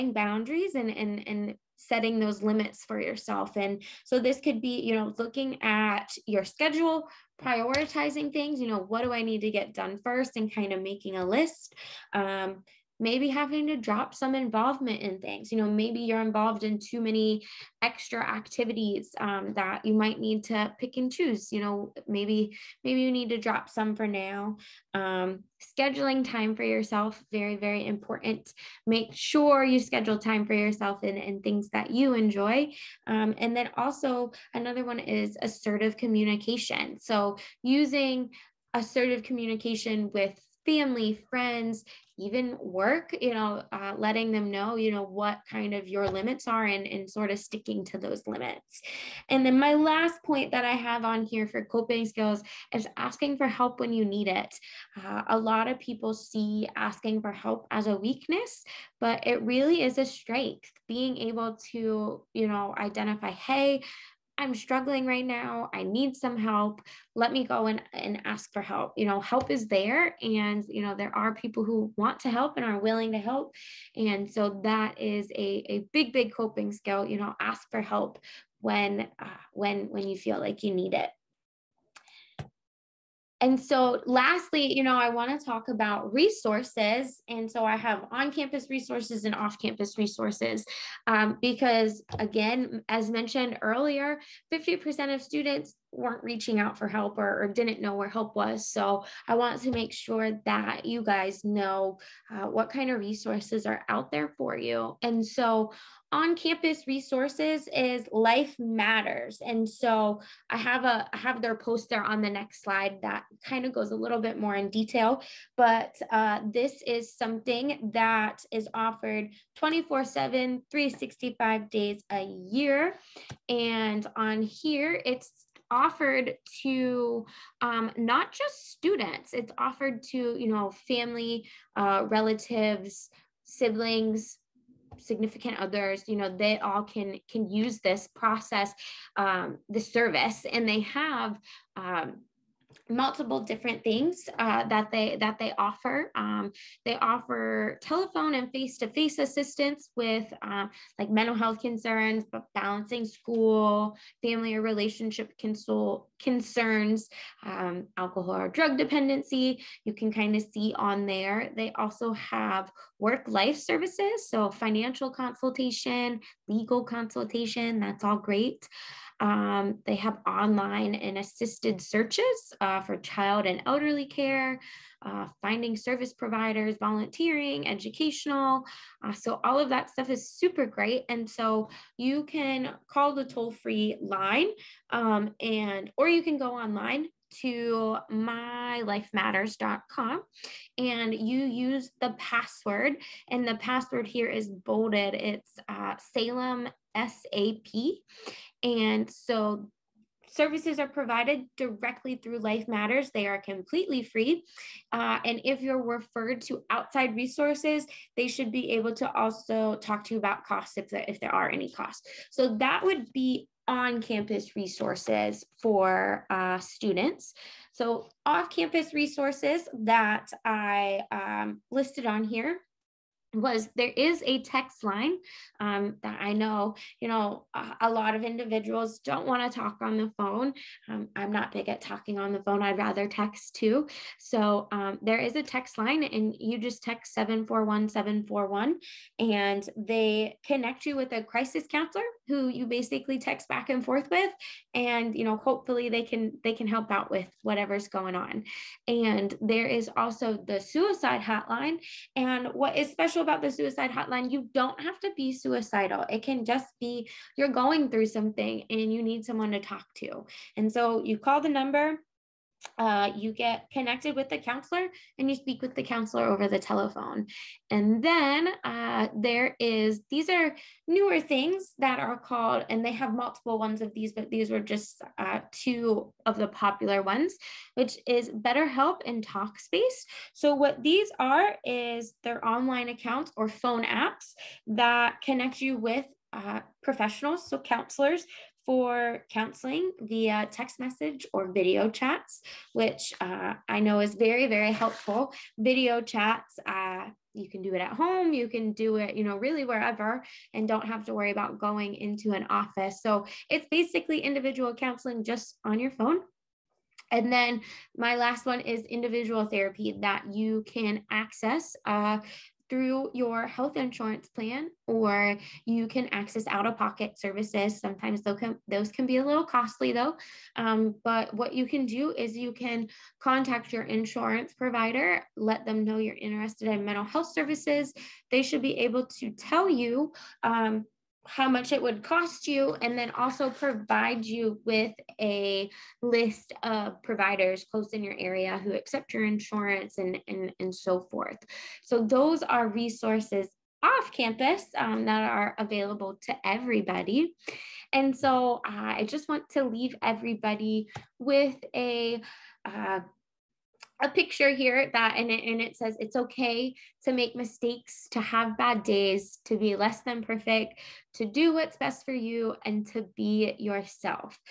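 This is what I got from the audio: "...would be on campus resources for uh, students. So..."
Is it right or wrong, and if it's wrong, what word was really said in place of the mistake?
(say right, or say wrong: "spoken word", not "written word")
right.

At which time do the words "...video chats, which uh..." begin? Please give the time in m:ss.
4:51.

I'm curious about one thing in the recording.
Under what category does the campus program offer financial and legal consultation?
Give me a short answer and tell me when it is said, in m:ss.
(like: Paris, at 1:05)
work-life services, at 2:42.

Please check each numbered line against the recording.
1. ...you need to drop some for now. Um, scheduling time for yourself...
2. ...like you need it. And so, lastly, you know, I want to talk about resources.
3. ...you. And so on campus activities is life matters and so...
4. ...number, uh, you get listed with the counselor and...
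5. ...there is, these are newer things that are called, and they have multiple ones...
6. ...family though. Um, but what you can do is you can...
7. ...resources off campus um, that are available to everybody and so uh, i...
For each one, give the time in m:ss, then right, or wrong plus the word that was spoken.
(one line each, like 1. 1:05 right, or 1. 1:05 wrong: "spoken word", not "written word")
1. 0:23 right
2. 1:20 right
3. 1:44 wrong: "resources", not "activities"
4. 4:21 wrong: "connected", not "listed"
5. 4:29 right
6. 5:19 wrong: "costly", not "family"
7. 5:42 right.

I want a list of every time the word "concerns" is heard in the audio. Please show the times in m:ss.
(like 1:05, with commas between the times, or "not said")
2:31, 2:36.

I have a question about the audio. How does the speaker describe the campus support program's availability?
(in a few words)
24/7, 365.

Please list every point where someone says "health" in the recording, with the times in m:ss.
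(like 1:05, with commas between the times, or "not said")
2:31, 5:13, 5:27.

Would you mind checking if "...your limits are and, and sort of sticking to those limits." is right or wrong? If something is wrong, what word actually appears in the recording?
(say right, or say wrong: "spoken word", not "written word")
right.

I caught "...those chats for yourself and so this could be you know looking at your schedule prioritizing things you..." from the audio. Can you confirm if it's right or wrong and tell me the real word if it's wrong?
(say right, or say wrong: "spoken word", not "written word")
wrong: "limits", not "chats".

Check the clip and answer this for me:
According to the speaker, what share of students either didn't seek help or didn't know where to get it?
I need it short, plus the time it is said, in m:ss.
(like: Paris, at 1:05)
50%, at 1:34.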